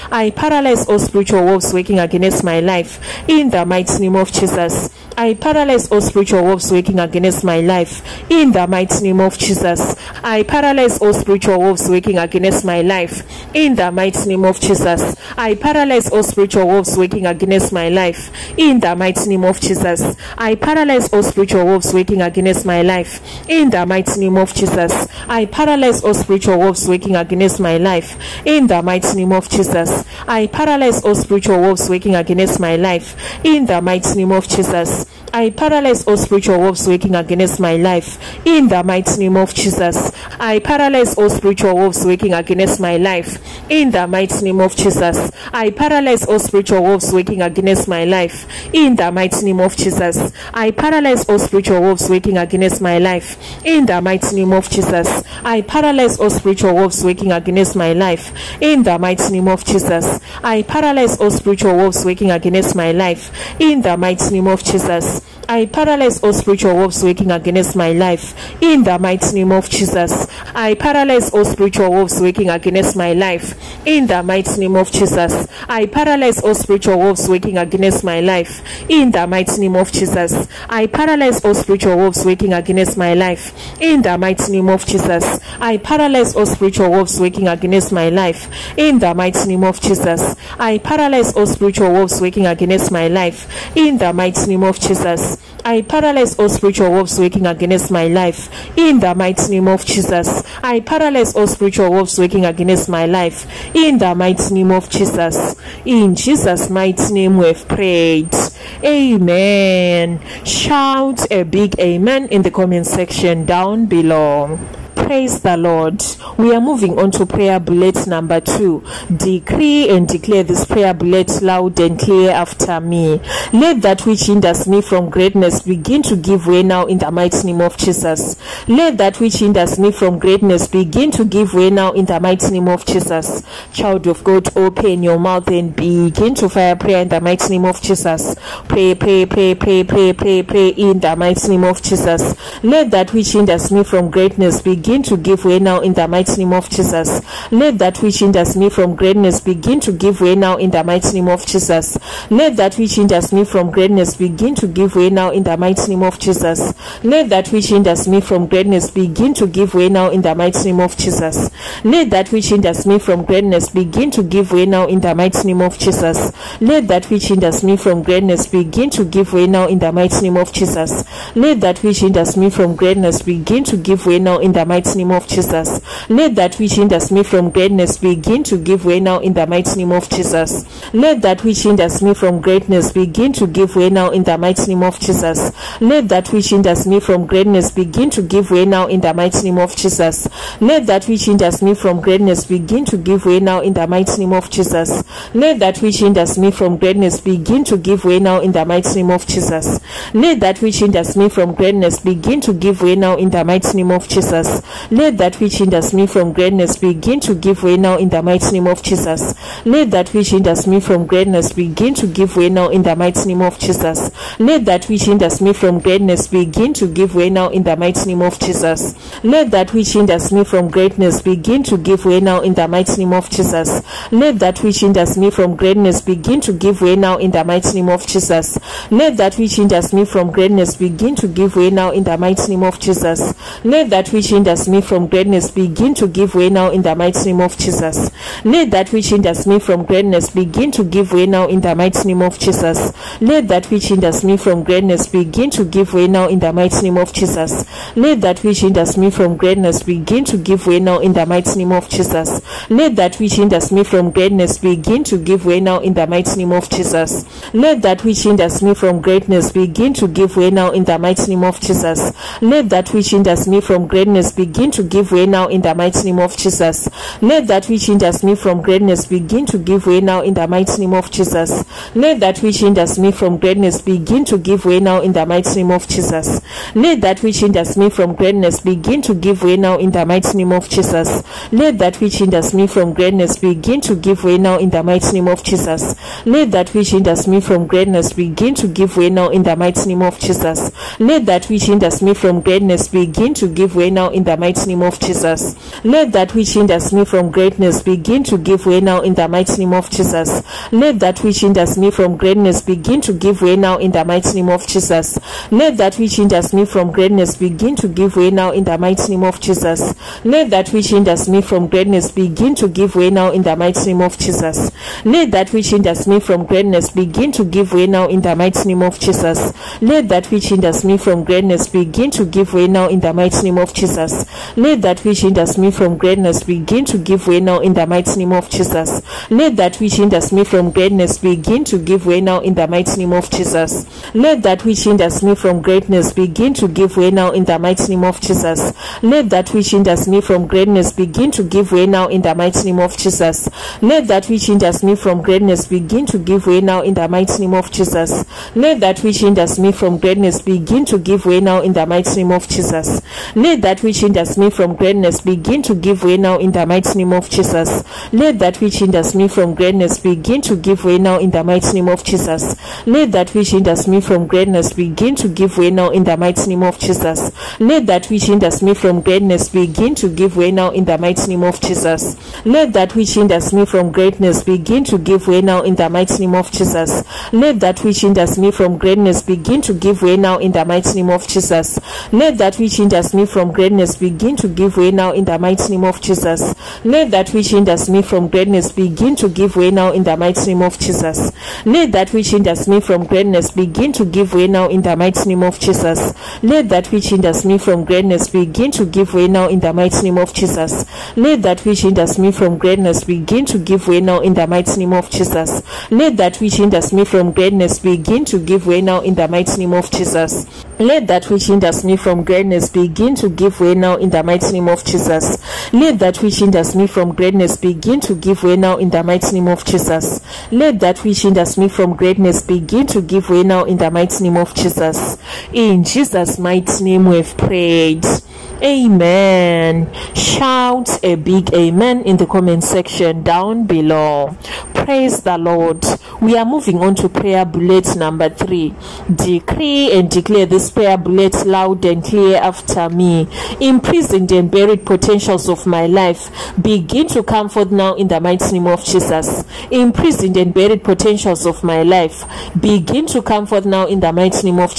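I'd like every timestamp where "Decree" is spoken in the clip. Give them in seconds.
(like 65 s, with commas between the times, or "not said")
119 s, 439 s.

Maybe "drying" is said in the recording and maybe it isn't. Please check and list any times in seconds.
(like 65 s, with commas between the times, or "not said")
not said.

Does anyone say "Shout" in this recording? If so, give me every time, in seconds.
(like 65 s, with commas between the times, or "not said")
110 s, 430 s.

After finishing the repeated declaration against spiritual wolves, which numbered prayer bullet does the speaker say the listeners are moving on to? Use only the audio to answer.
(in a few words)
2.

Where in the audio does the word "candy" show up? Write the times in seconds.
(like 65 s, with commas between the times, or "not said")
not said.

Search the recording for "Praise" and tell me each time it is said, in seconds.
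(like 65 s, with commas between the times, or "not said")
115 s, 434 s.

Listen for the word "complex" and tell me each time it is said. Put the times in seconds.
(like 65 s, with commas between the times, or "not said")
not said.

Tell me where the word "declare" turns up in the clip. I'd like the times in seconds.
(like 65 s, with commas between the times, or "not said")
120 s, 440 s.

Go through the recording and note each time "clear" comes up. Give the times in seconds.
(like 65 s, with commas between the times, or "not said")
121 s, 442 s.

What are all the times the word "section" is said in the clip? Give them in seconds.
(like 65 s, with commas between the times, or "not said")
112 s, 432 s.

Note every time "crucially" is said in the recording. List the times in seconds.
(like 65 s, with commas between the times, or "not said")
not said.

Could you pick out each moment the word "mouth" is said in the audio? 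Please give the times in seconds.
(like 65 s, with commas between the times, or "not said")
135 s.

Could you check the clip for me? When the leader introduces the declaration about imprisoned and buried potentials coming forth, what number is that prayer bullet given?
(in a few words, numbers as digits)
3.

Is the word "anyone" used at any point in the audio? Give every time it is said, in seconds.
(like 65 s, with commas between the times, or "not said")
not said.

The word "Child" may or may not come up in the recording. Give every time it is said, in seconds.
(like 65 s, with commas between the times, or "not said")
133 s.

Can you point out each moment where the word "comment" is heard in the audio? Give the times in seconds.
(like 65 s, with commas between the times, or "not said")
112 s, 432 s.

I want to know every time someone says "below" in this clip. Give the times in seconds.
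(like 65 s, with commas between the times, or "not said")
113 s, 433 s.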